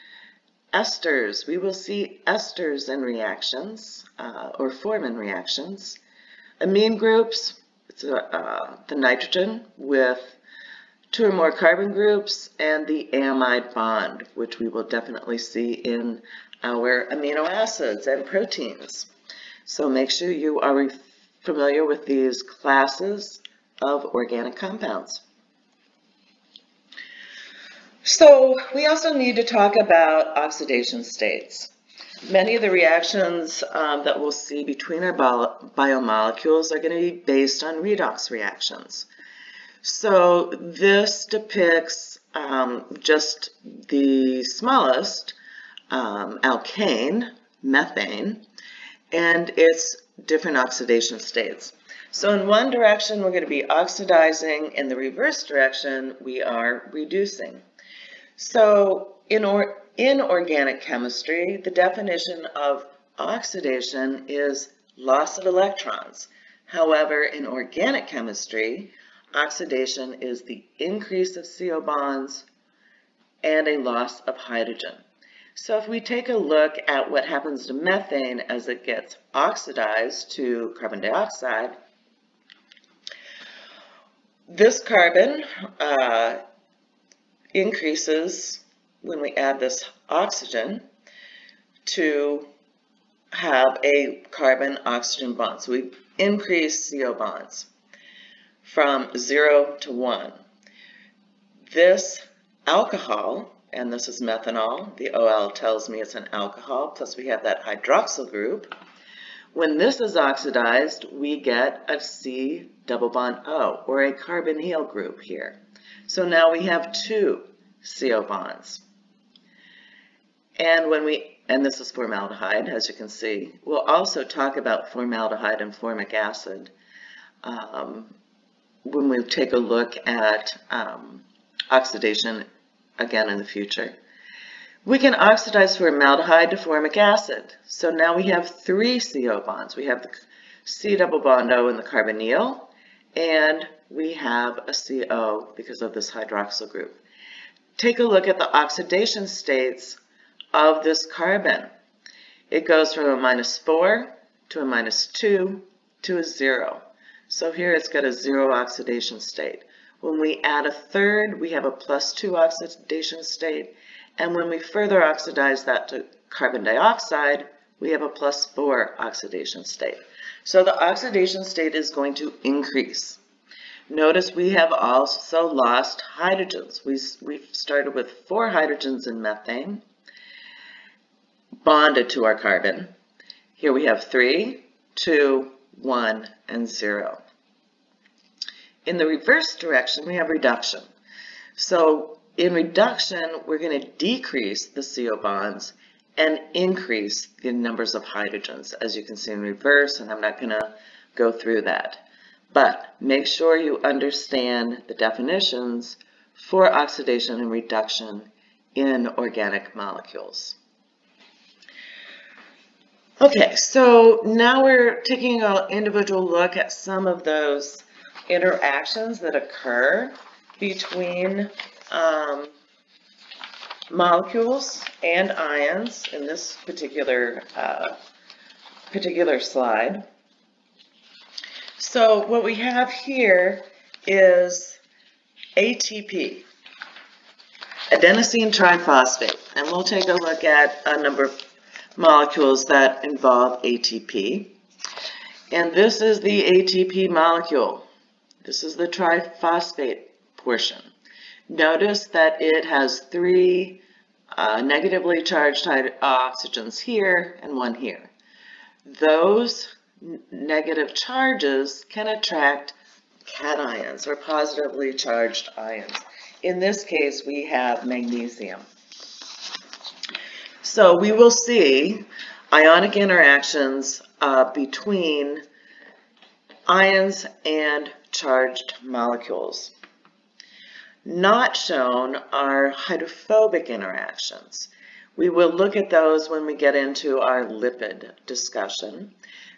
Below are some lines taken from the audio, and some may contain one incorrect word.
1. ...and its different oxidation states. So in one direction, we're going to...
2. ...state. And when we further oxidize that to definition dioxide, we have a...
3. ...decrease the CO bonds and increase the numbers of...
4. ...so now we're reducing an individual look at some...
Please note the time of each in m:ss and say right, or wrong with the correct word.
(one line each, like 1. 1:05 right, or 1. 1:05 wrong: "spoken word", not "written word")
1. 0:49 right
2. 2:43 wrong: "carbon", not "definition"
3. 3:13 right
4. 3:33 wrong: "taking", not "reducing".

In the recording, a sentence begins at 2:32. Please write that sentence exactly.
It goes from a minus 4 to a minus 2 to a 0.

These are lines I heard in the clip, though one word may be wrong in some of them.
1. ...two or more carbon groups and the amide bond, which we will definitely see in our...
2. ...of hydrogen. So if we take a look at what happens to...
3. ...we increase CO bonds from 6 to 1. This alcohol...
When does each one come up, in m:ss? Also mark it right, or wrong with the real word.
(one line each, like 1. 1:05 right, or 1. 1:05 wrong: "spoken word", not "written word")
1. 0:11 right
2. 1:14 right
3. 1:35 wrong: "0", not "6".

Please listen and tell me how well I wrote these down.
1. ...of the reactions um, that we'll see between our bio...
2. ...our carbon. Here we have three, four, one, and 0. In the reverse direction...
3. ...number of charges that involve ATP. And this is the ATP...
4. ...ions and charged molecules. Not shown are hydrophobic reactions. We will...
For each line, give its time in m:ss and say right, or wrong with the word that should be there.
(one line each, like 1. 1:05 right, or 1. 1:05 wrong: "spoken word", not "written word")
1. 0:32 right
2. 3:02 wrong: "two", not "four"
3. 4:01 wrong: "molecules", not "charges"
4. 4:36 wrong: "interactions", not "reactions".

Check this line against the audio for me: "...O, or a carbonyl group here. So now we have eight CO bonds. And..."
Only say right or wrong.
wrong.